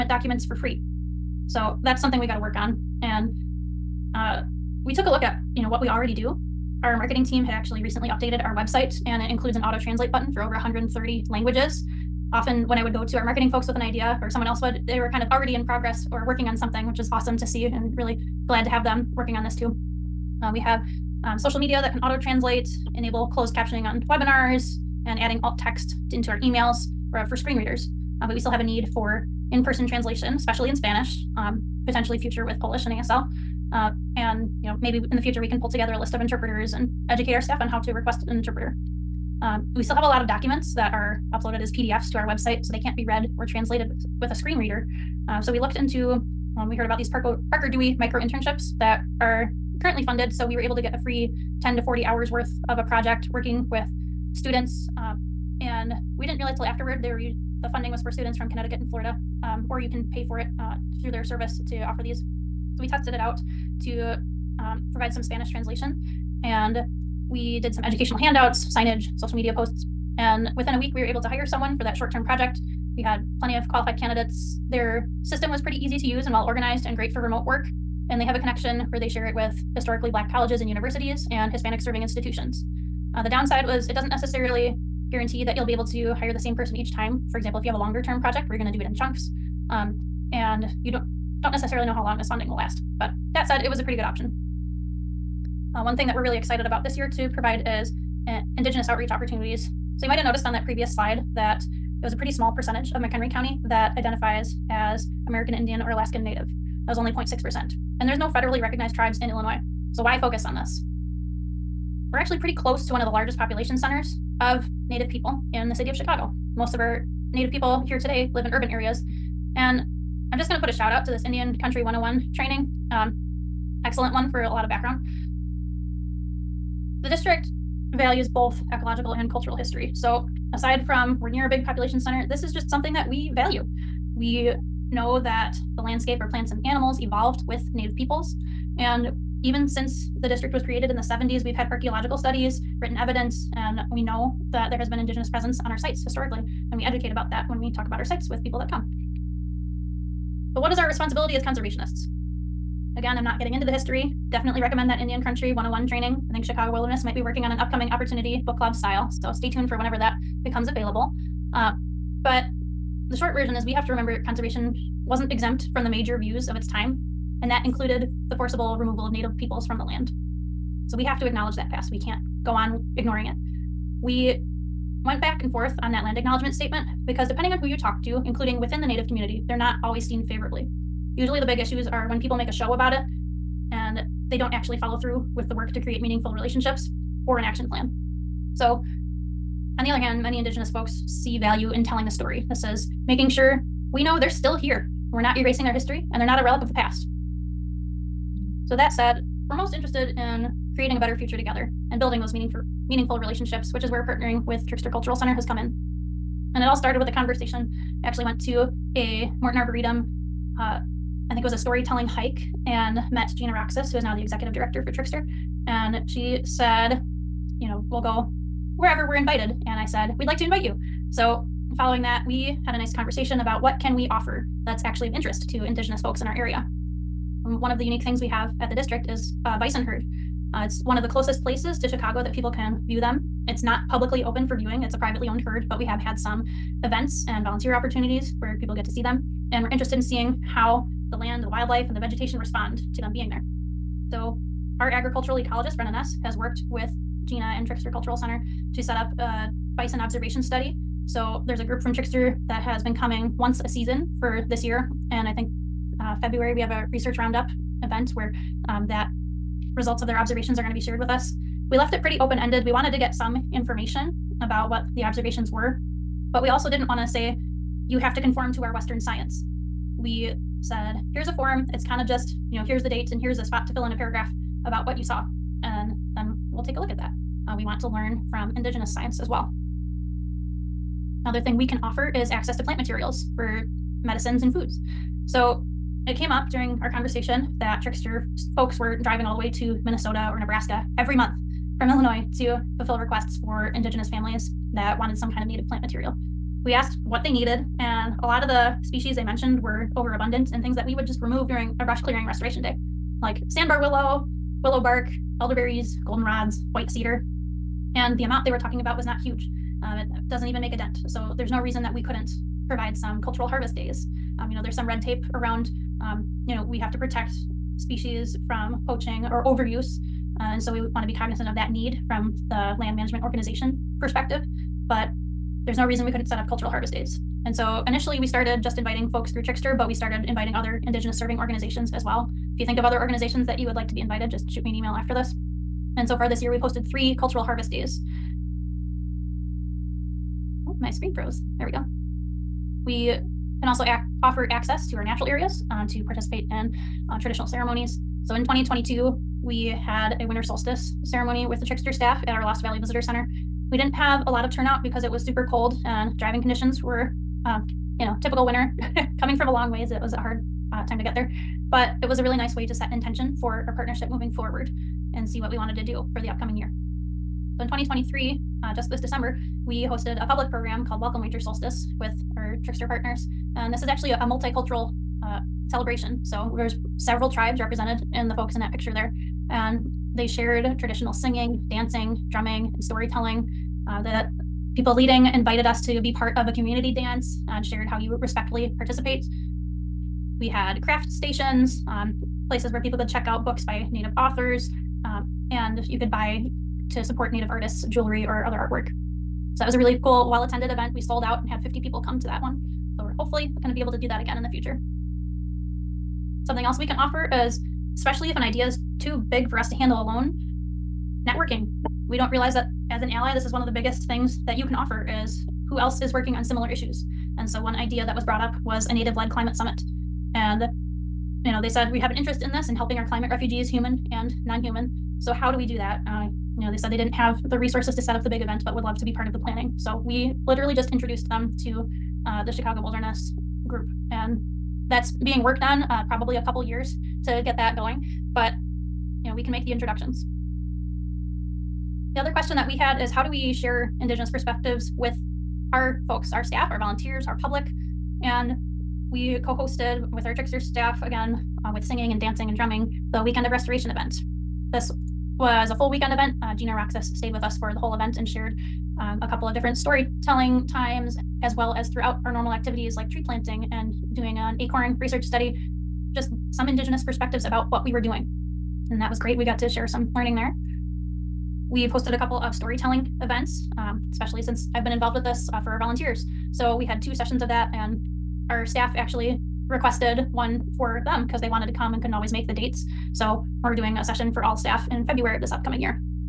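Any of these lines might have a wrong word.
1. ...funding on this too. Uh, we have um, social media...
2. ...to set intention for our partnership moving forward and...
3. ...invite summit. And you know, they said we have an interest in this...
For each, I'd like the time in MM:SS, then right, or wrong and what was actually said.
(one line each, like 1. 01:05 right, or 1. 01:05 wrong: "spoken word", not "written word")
1. 00:19 wrong: "working", not "funding"
2. 06:02 right
3. 06:59 wrong: "climate", not "invite".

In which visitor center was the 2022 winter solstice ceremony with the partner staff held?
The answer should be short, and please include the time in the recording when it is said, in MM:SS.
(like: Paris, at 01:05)
Lost Valley Visitor Center, at 05:52.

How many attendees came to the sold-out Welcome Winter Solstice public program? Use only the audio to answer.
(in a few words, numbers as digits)
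50.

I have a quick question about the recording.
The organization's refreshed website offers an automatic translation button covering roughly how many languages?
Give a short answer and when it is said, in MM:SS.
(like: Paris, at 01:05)
over 130, at 00:10.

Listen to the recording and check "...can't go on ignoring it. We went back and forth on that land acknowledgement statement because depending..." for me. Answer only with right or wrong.
right.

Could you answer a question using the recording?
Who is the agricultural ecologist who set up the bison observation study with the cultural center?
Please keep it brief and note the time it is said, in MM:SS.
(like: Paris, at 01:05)
Brenna Ness, at 04:05.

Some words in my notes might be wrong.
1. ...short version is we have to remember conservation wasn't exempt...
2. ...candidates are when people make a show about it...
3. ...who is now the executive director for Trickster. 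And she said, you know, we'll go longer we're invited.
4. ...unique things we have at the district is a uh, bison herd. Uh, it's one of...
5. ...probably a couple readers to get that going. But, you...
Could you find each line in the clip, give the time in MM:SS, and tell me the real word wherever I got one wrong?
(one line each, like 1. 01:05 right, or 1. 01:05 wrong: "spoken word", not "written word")
1. 02:43 right
2. 03:01 wrong: "issues", not "candidates"
3. 03:33 wrong: "wherever", not "longer"
4. 03:47 right
5. 07:16 wrong: "years", not "readers".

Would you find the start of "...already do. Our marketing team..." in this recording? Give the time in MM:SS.
00:05.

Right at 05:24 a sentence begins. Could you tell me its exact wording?
But there's no reason we couldn't set up cultural harvest days.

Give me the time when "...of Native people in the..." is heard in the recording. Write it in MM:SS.
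01:54.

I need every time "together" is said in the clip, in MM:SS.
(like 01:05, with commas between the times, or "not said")
00:35, 03:21.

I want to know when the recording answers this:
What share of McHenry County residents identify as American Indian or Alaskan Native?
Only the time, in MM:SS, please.
01:47.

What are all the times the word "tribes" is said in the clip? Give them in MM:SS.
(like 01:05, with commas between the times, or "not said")
01:48, 06:17.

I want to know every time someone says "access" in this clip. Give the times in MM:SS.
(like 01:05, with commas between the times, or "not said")
04:42, 05:44.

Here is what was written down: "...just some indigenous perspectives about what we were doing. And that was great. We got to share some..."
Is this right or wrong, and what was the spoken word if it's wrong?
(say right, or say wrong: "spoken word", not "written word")
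right.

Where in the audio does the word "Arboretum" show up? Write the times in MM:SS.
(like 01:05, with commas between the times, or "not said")
03:29.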